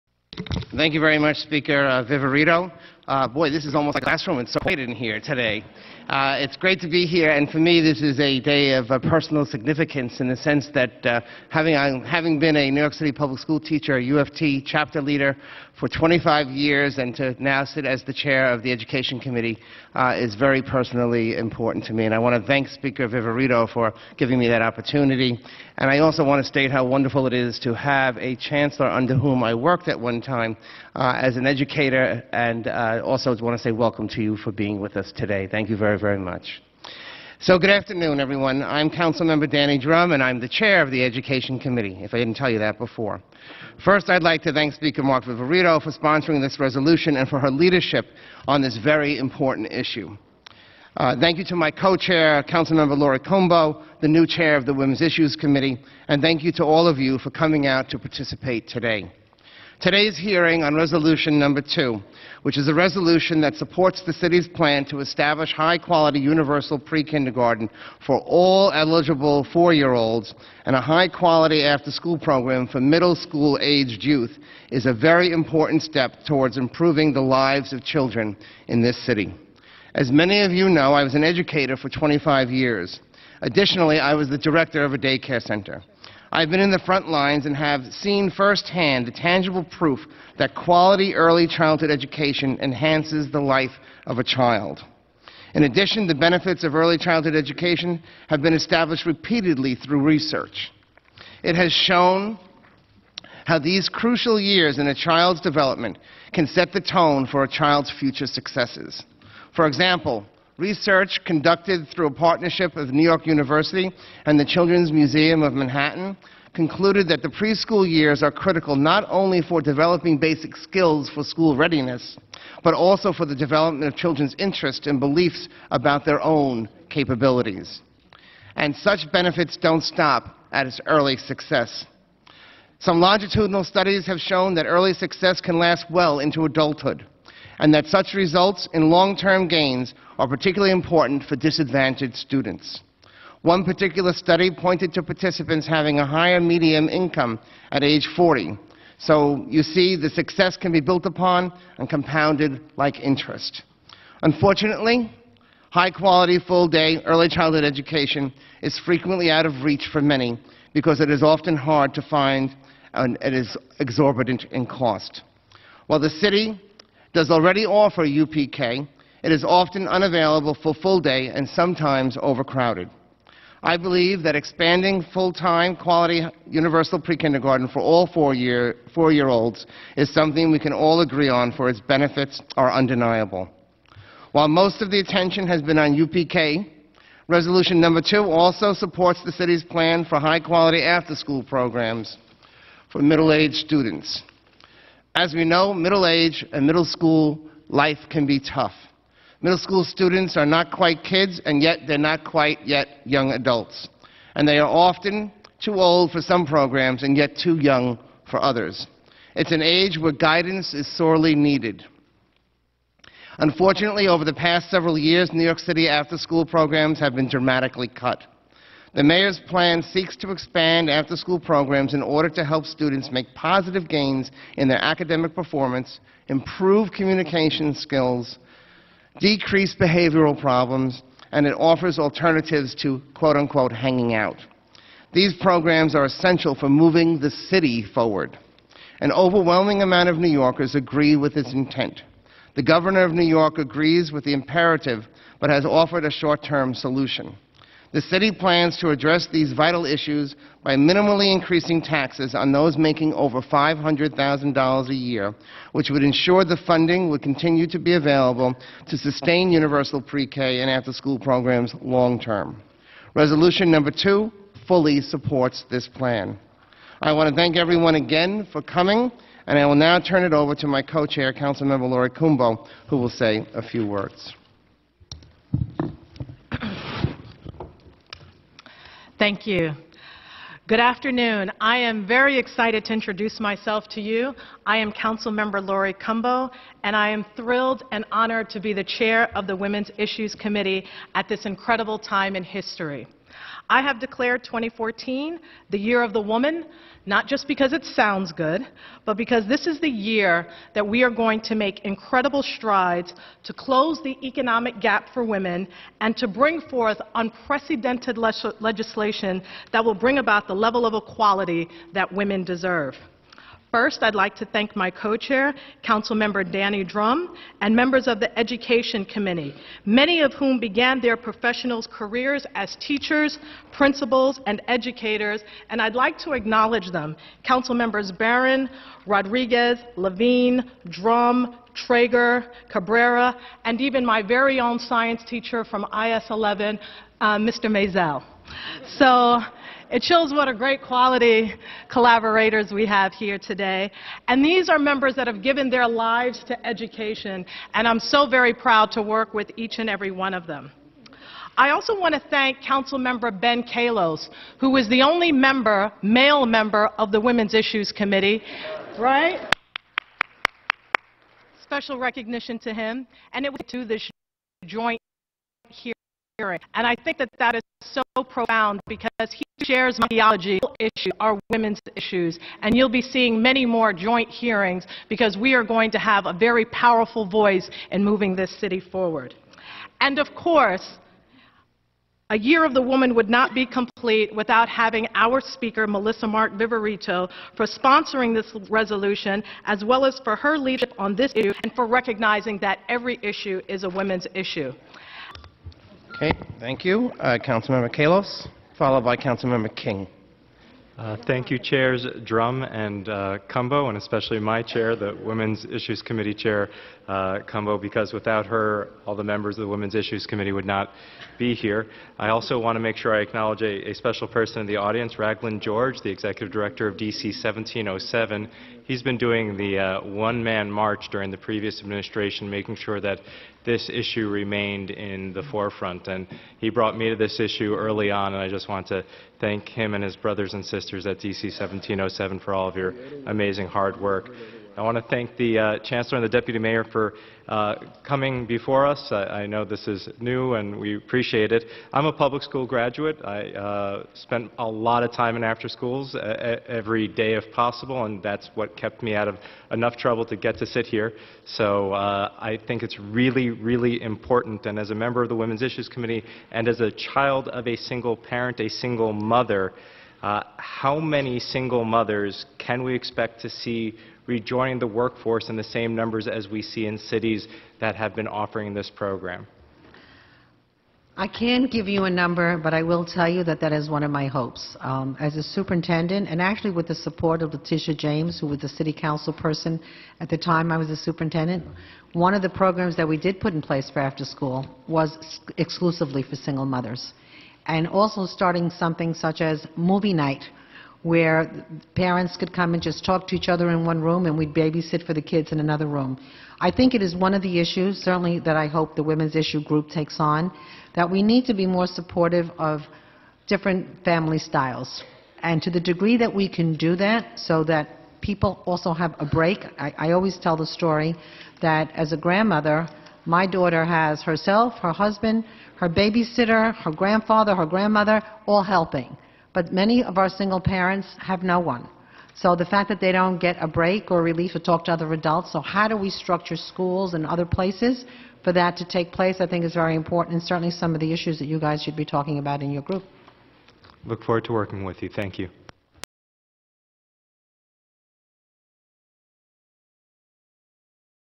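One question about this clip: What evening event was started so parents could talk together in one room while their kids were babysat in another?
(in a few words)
Movie night.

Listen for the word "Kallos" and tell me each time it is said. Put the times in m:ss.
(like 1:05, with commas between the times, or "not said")
5:53, 6:37.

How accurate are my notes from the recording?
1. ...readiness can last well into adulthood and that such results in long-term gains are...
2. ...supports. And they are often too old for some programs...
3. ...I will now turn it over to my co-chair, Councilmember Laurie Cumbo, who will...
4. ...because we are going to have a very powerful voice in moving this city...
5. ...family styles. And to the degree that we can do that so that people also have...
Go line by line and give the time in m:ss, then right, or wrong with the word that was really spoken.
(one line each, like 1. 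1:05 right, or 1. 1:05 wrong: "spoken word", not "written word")
1. 2:14 wrong: "success", not "readiness"
2. 3:23 wrong: "adults", not "supports"
3. 4:29 right
4. 6:15 right
5. 8:24 right.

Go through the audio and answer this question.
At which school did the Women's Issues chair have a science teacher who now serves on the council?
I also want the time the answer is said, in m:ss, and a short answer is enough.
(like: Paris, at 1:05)
IS 11, at 5:35.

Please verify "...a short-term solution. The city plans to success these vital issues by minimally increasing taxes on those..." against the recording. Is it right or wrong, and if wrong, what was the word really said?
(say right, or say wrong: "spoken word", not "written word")
wrong: "address", not "success".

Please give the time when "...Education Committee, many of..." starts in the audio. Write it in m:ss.
5:18.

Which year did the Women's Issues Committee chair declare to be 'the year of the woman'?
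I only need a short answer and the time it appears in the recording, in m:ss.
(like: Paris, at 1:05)
2014, at 4:54.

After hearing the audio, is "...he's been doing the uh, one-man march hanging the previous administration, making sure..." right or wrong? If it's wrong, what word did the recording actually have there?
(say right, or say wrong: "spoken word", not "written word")
wrong: "during", not "hanging".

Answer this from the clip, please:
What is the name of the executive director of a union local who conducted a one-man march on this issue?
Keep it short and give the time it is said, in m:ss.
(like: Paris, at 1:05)
Raglan George, at 6:55.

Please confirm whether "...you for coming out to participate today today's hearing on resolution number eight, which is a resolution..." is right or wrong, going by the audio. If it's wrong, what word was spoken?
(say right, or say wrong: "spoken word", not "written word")
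wrong: "two", not "eight".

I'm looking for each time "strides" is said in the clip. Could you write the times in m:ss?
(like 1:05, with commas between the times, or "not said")
5:02.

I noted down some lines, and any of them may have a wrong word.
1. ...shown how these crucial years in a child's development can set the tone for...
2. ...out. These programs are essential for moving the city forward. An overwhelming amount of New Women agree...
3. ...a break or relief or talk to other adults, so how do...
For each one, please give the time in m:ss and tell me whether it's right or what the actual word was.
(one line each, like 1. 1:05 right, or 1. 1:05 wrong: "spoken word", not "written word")
1. 1:41 right
2. 3:54 wrong: "Yorkers", not "Women"
3. 8:43 right.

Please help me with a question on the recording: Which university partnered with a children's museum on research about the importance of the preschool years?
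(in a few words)
New York University.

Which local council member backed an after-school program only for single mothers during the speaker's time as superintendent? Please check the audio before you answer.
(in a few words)
Letitia James.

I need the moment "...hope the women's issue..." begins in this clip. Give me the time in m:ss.
8:18.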